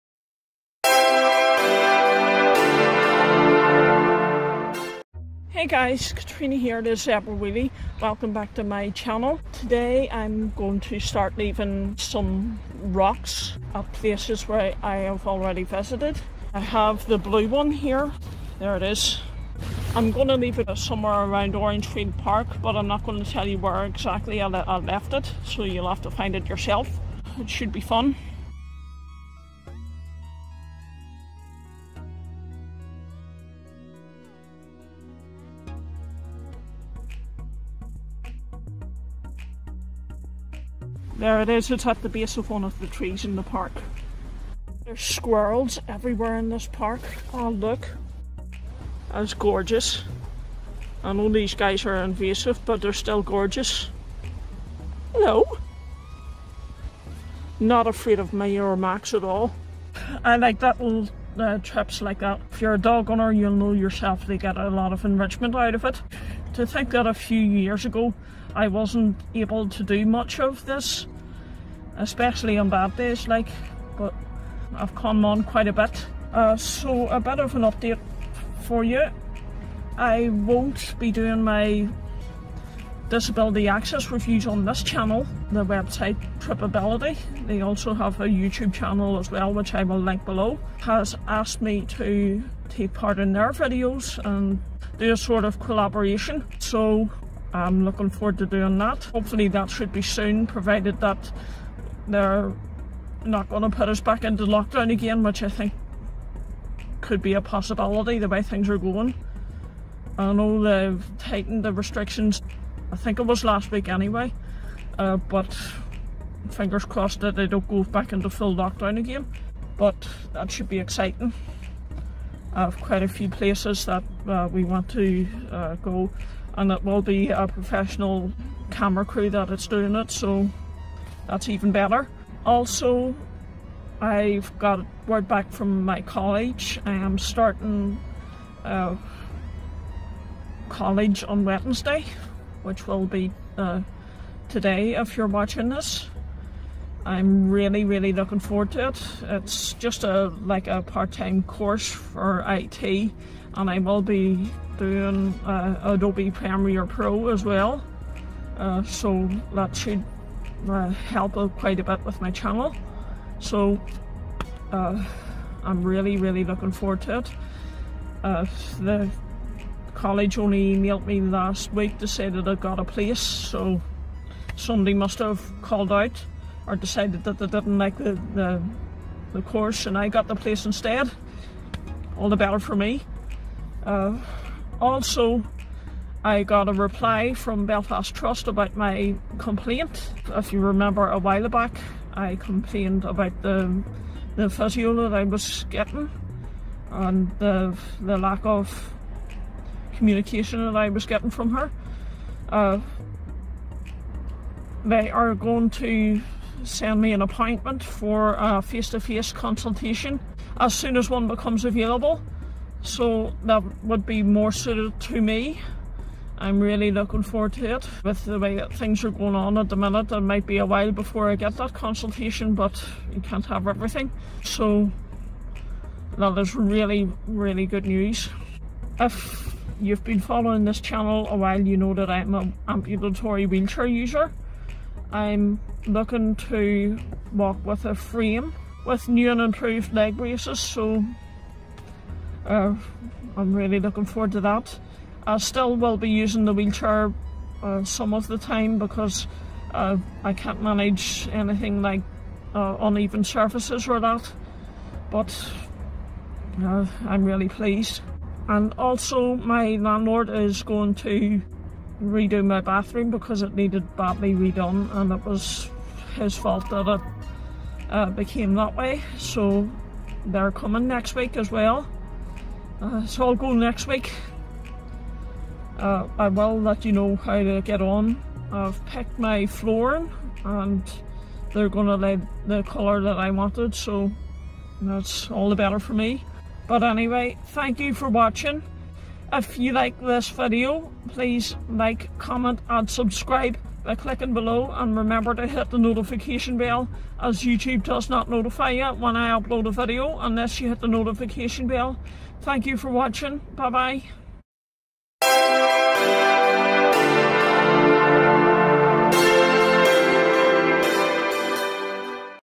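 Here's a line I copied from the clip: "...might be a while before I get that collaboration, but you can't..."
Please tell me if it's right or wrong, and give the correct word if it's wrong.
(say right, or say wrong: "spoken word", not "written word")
wrong: "consultation", not "collaboration".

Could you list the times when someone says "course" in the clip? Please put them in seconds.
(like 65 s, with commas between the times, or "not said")
151 s, 179 s.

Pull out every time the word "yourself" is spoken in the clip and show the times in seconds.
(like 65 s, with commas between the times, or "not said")
26 s, 63 s.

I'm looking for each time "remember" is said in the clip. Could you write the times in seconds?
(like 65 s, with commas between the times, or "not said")
190 s, 294 s.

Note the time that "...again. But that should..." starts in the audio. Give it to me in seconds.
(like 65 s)
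118 s.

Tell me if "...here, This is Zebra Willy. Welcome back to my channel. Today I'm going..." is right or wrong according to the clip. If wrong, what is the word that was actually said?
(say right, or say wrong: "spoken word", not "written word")
right.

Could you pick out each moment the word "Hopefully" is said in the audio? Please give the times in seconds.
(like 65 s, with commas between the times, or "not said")
99 s.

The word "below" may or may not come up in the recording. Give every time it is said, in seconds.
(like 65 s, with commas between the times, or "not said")
90 s, 294 s.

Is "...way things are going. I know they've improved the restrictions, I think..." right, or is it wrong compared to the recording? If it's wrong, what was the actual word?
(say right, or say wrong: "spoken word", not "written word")
wrong: "tightened", not "improved".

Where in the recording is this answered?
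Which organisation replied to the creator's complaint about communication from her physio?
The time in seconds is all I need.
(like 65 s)
187 s.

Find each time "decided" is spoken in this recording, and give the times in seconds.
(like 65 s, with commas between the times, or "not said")
176 s.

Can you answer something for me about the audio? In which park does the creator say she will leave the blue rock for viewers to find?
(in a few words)
Orangefield Park.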